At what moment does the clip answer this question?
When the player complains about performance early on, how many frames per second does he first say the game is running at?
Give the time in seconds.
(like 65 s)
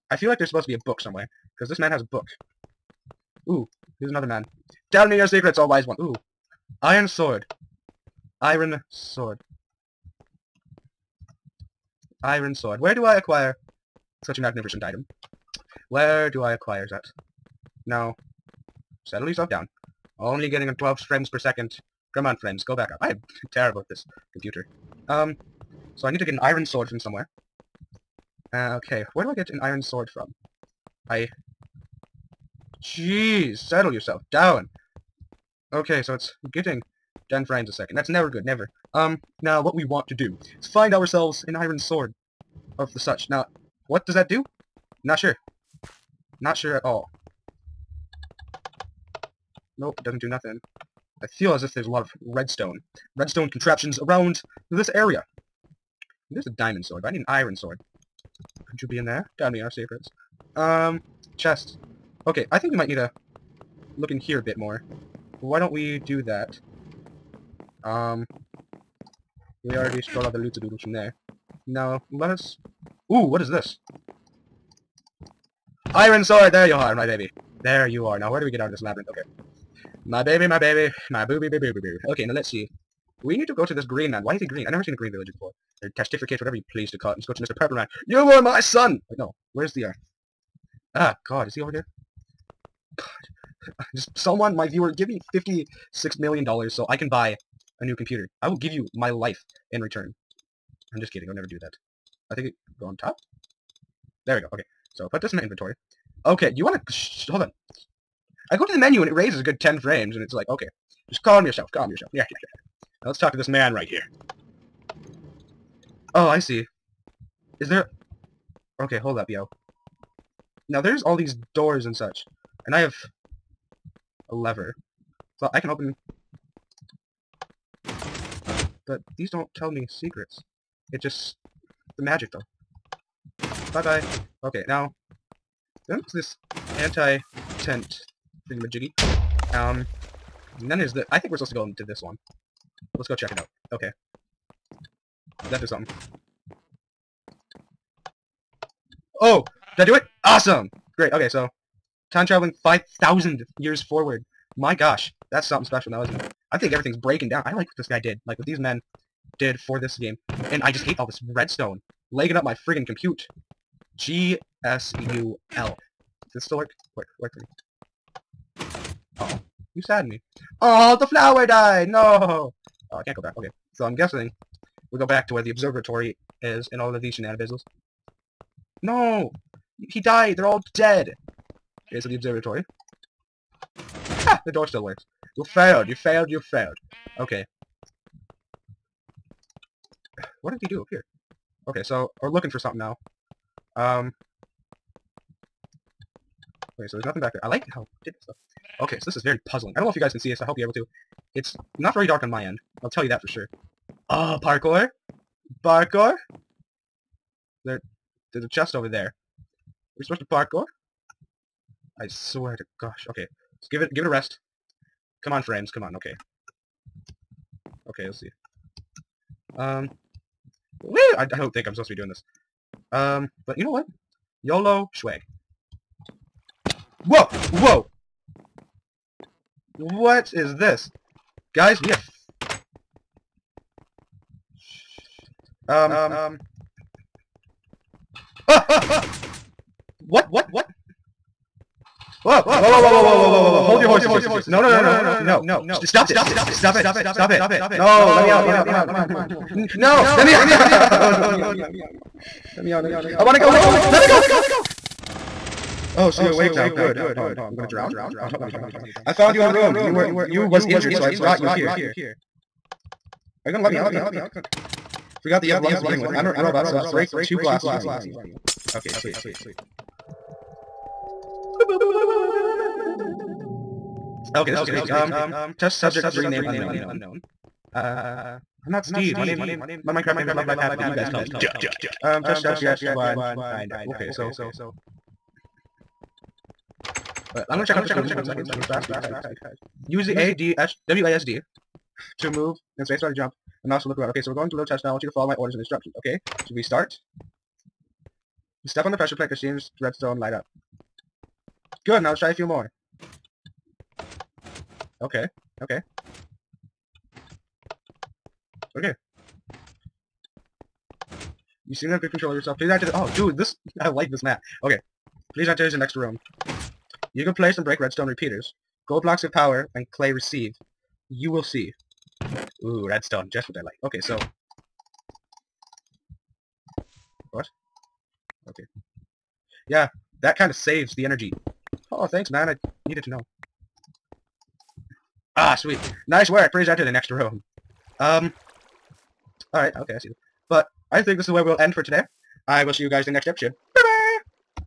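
20 s.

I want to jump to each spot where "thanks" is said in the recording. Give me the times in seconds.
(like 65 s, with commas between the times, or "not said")
332 s.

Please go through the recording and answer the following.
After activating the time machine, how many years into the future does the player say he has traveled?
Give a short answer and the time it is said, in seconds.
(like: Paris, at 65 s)
5,000, at 152 s.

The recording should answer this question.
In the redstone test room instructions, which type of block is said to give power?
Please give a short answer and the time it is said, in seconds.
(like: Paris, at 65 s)
Gold blocks, at 318 s.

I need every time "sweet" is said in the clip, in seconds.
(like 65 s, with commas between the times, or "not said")
268 s, 335 s.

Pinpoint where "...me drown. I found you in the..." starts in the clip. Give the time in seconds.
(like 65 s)
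258 s.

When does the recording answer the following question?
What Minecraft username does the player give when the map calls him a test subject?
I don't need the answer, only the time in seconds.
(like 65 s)
280 s.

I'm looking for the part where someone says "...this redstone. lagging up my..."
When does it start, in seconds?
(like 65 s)
161 s.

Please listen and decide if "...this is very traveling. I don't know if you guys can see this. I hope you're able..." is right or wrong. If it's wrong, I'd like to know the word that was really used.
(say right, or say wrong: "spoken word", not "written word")
wrong: "puzzling", not "traveling".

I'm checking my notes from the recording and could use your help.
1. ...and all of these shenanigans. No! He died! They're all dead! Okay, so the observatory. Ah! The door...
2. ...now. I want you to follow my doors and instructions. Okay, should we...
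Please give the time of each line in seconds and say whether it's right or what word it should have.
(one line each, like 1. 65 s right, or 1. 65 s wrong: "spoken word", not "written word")
1. 176 s right
2. 294 s wrong: "orders", not "doors".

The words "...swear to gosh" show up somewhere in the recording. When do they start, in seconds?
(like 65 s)
212 s.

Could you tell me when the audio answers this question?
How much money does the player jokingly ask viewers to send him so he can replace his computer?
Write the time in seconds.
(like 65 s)
95 s.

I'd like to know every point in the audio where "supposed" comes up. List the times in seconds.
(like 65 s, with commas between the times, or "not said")
0 s, 141 s, 210 s, 221 s.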